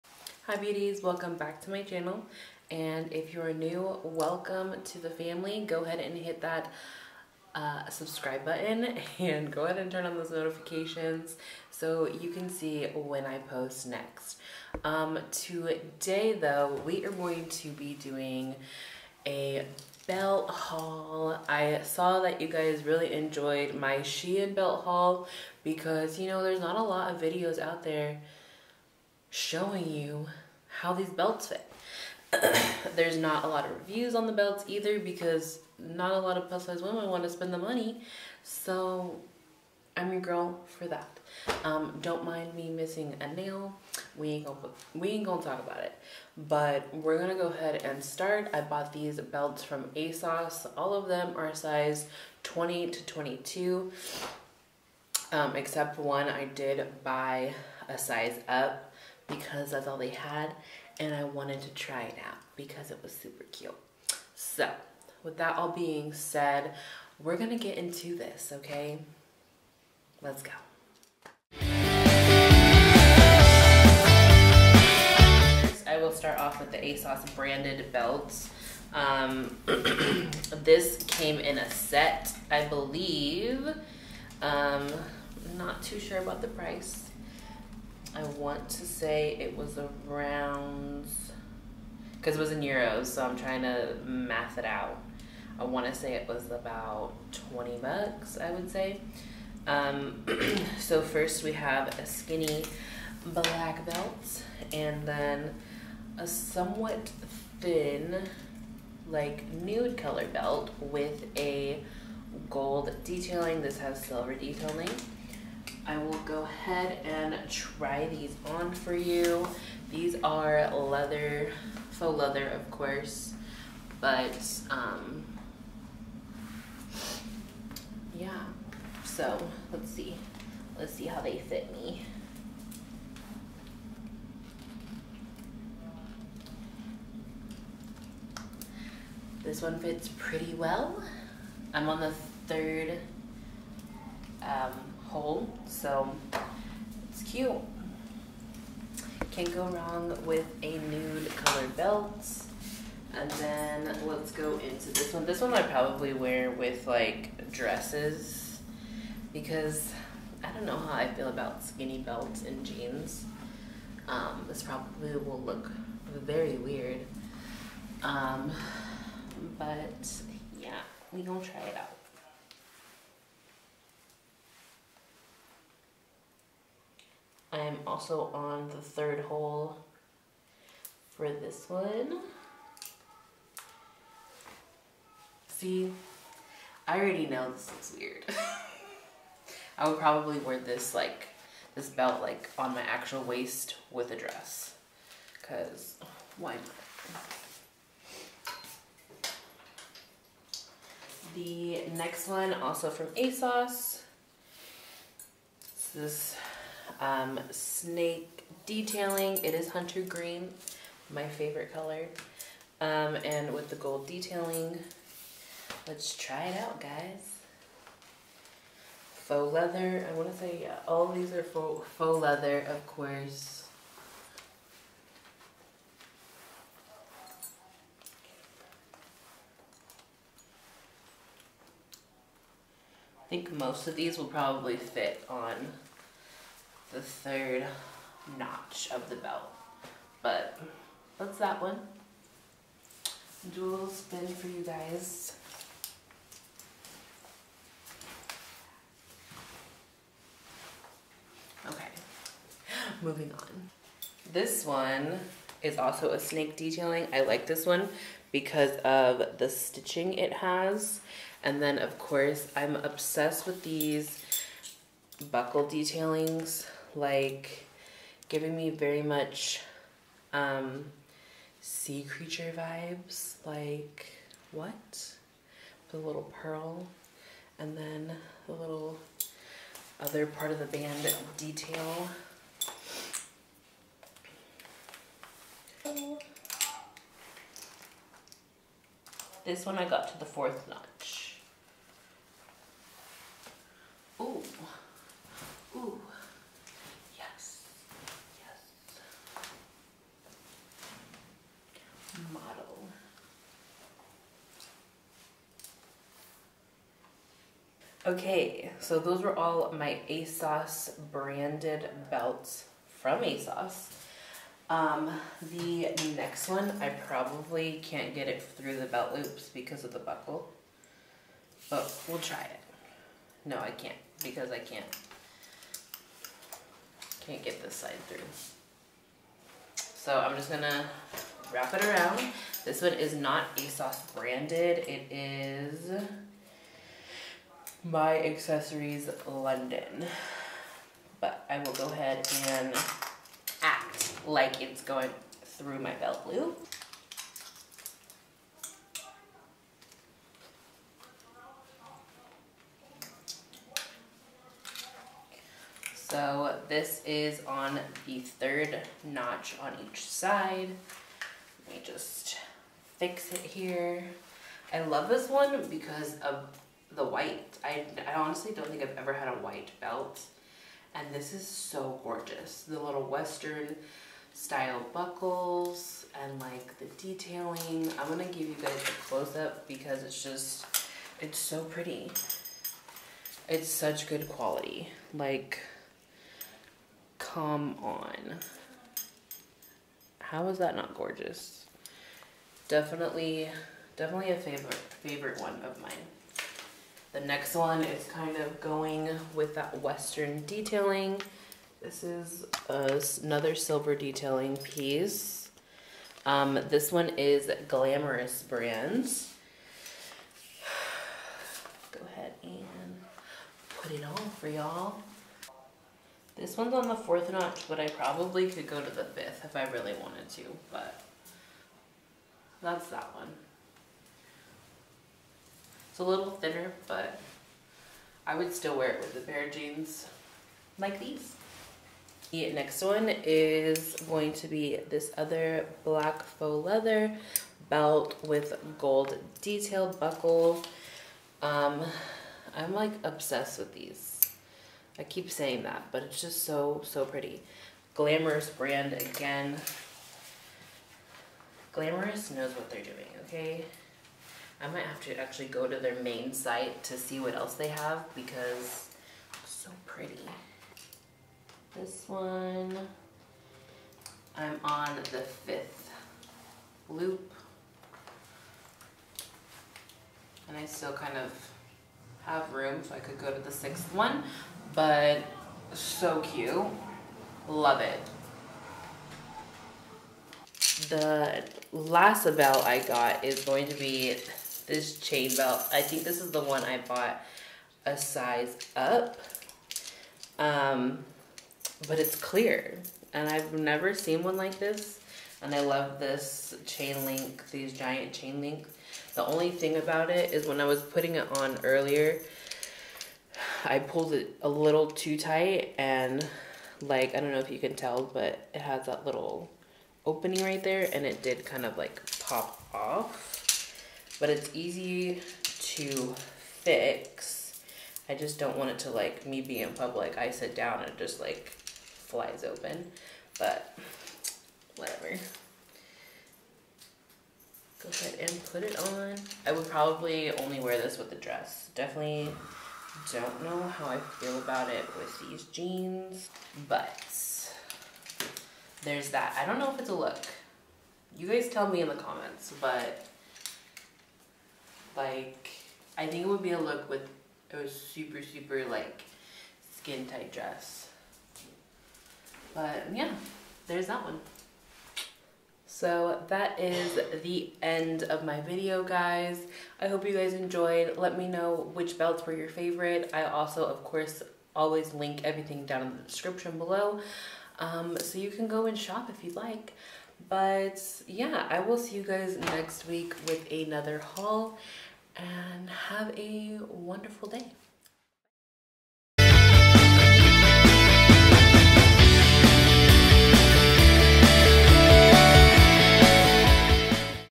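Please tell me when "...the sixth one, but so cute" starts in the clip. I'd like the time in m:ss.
7:53.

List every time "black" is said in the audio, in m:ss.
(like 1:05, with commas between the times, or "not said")
1:43, 7:15.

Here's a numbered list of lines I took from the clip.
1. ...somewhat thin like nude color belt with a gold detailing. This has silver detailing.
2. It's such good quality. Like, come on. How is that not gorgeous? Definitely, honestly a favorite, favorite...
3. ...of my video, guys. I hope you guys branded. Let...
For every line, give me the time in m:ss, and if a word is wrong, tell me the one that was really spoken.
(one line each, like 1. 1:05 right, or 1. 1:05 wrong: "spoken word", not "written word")
1. 1:46 right
2. 6:23 wrong: "definitely", not "honestly"
3. 9:18 wrong: "enjoyed", not "branded".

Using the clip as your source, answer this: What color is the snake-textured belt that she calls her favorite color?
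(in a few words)
Hunter green.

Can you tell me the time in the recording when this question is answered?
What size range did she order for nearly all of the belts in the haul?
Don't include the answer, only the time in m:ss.
0:52.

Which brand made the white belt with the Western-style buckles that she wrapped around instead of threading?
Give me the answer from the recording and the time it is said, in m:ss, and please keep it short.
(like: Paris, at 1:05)
Accessories London, at 5:38.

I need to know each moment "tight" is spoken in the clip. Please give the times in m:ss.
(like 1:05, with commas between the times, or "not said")
8:25, 9:10.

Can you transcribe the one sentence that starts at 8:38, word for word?
I just don't want it to like me be in public.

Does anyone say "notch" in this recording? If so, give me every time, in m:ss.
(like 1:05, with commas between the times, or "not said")
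3:58, 4:50, 5:59, 6:57.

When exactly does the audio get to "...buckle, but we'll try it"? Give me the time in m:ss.
5:19.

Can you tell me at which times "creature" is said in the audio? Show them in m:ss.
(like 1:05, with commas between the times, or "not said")
4:32.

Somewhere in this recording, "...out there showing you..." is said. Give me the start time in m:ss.
0:27.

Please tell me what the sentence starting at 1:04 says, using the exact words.
So with that all being said, we're gonna get into this, okay?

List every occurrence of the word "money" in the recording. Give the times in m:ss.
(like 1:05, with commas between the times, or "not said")
0:37.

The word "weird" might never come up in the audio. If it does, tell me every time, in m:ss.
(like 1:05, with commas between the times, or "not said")
2:46, 3:07.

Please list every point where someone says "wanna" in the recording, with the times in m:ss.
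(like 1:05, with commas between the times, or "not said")
3:40.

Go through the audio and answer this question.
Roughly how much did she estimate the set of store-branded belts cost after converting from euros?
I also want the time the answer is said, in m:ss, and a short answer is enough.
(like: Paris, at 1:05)
About 20 bucks, at 1:37.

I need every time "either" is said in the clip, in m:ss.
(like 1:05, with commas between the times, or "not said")
0:34.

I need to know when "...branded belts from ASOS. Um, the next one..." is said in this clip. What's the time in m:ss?
5:11.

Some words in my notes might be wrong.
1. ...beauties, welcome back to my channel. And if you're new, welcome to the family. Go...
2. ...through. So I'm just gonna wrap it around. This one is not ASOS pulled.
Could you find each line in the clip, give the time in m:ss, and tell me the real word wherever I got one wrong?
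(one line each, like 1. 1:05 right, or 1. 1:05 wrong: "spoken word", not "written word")
1. 0:00 right
2. 5:28 wrong: "branded", not "pulled".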